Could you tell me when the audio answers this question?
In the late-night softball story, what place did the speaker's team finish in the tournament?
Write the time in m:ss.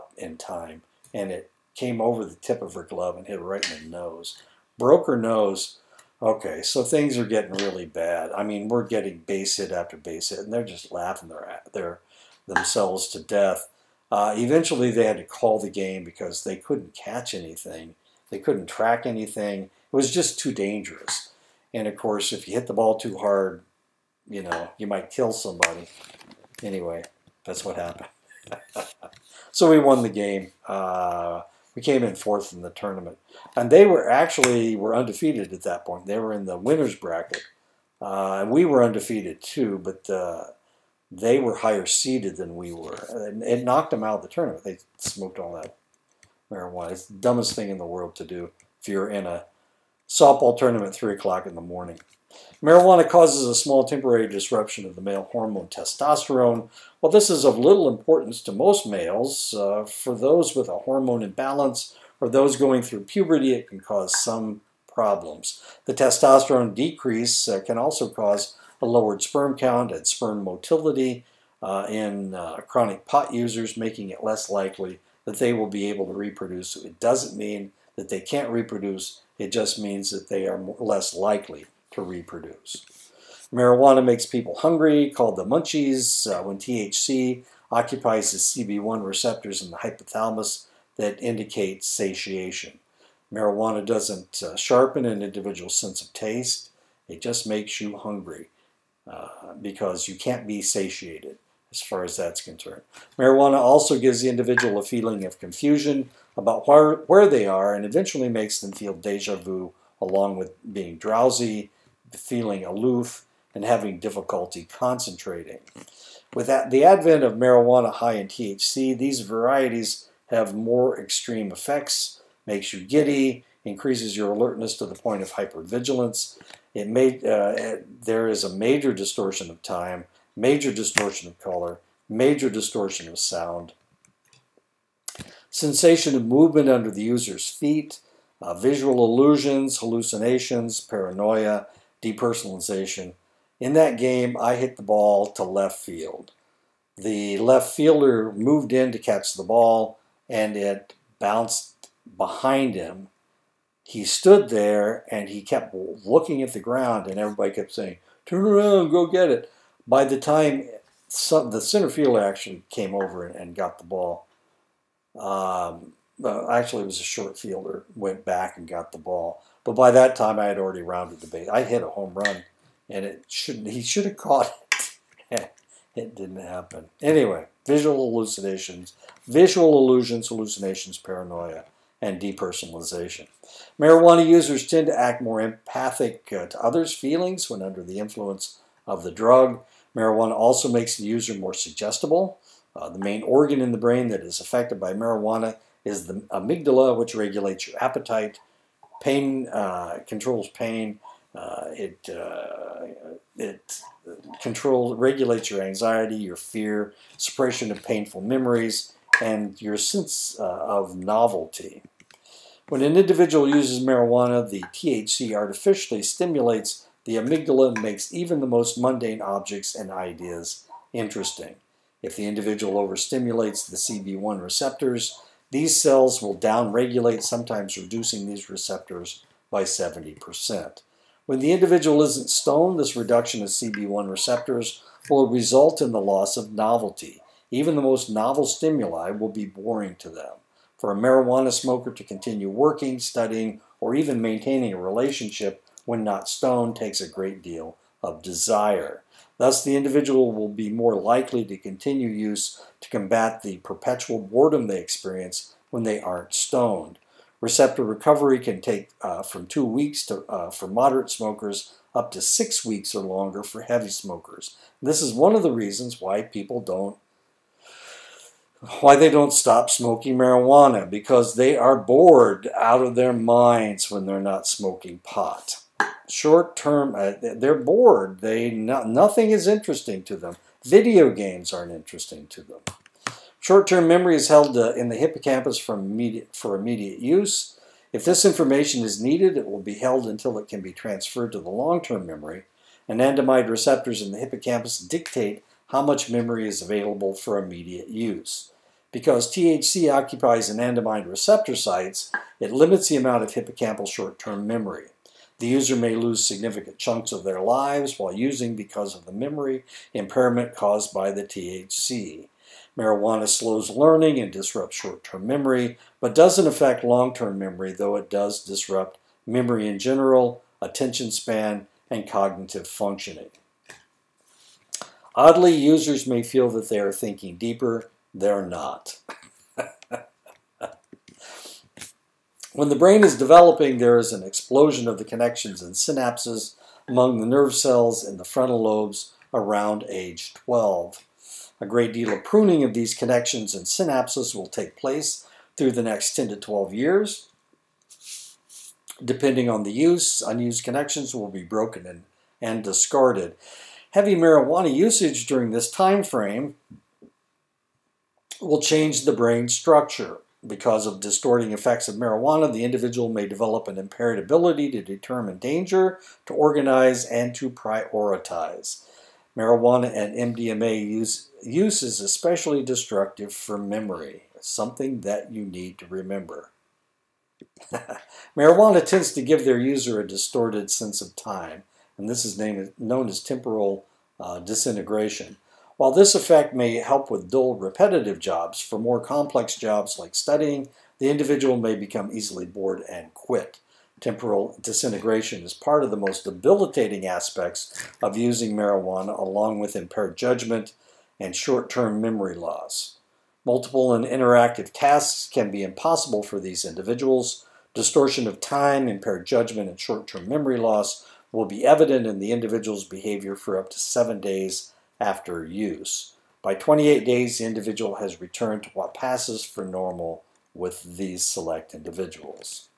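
0:32.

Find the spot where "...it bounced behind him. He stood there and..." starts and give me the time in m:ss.
2:30.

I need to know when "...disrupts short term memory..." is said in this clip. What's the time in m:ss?
5:14.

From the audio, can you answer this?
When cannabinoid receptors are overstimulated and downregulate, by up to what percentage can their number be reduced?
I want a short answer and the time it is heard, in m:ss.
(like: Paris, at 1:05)
70%, at 3:49.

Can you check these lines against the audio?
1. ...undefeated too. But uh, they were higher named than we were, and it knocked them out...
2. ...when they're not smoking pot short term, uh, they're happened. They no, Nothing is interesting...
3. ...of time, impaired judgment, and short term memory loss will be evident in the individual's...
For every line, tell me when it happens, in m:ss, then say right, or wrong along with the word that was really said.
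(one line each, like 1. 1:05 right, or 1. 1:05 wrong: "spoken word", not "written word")
1. 0:38 wrong: "seeded", not "named"
2. 4:33 wrong: "bored", not "happened"
3. 6:48 right.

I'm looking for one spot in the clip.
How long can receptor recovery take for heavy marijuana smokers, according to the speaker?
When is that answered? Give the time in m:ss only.
4:22.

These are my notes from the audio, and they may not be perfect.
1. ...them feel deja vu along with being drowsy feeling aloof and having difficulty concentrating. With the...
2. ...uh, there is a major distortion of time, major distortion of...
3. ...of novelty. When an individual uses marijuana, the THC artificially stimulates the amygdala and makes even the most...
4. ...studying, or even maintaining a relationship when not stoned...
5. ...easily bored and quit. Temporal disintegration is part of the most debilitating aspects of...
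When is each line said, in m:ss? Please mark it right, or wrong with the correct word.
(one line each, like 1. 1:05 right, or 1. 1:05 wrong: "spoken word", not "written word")
1. 1:48 right
2. 2:07 right
3. 3:30 right
4. 4:02 right
5. 6:32 right.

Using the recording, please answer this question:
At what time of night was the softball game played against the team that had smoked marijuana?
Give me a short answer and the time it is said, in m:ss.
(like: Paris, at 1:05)
3 o'clock in the morning, at 0:50.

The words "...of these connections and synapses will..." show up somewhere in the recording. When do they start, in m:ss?
5:42.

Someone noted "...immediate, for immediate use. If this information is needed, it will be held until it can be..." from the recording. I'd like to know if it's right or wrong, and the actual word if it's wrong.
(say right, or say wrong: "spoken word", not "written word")
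right.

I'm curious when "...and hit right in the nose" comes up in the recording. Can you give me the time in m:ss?
0:03.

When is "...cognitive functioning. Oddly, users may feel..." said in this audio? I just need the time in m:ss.
5:22.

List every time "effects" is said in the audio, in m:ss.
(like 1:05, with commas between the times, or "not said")
2:01, 6:01, 6:26.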